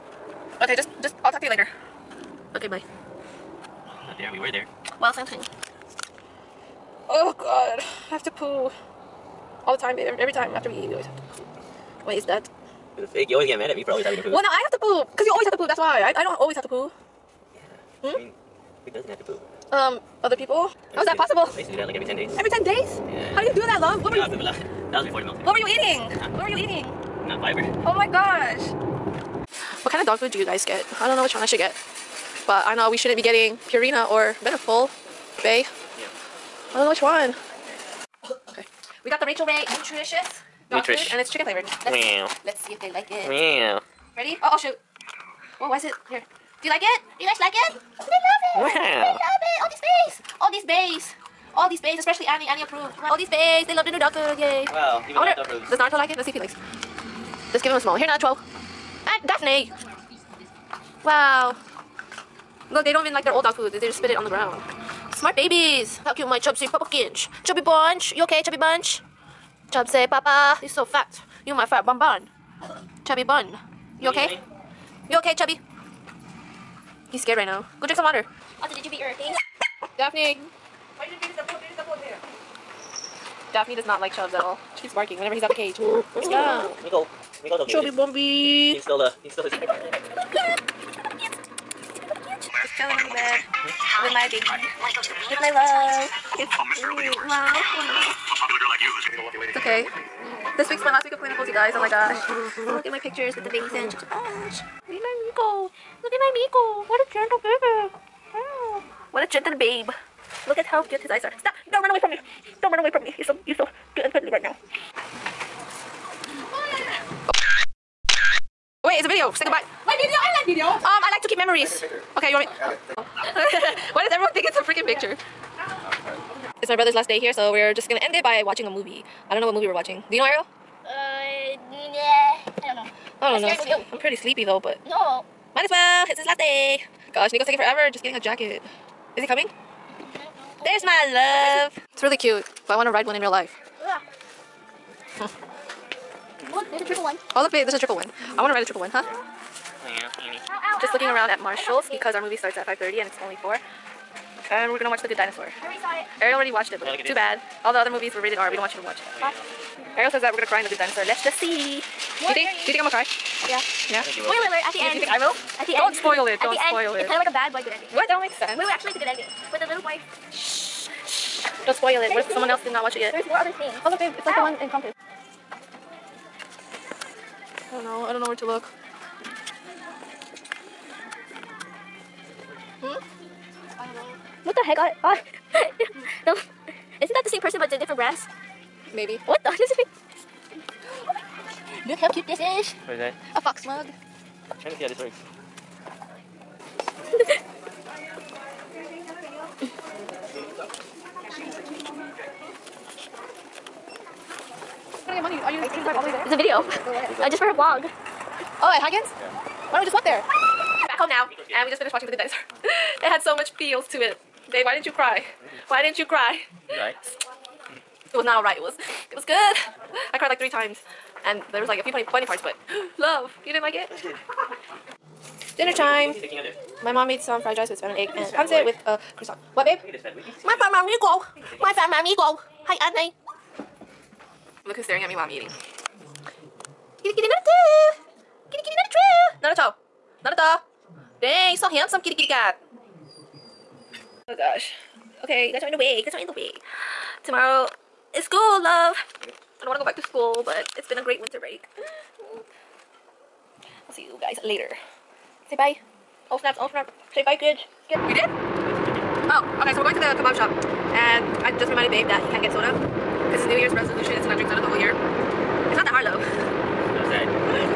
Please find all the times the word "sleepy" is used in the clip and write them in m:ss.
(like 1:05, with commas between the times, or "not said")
2:14.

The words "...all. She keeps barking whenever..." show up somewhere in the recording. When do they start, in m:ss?
1:24.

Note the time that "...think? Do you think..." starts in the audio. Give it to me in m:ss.
2:42.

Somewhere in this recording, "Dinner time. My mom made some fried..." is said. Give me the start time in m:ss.
3:45.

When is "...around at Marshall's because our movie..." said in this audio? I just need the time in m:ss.
2:31.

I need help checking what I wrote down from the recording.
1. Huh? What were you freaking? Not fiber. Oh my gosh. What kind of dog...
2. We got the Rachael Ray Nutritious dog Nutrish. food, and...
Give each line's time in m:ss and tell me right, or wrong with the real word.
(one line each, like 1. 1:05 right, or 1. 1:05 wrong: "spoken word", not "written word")
1. 0:25 wrong: "eating", not "freaking"
2. 0:39 right.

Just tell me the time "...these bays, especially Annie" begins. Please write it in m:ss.
0:51.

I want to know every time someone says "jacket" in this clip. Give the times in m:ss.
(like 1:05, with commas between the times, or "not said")
2:18.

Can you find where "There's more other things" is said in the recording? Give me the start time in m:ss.
2:53.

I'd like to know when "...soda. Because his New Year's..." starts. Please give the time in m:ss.
4:22.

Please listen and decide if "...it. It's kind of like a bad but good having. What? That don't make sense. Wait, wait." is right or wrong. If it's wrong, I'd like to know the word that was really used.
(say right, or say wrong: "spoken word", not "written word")
wrong: "ending", not "having".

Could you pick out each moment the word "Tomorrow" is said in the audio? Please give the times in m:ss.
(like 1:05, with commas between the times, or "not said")
4:07.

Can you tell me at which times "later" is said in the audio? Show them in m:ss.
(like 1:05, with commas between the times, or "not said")
0:01, 4:14.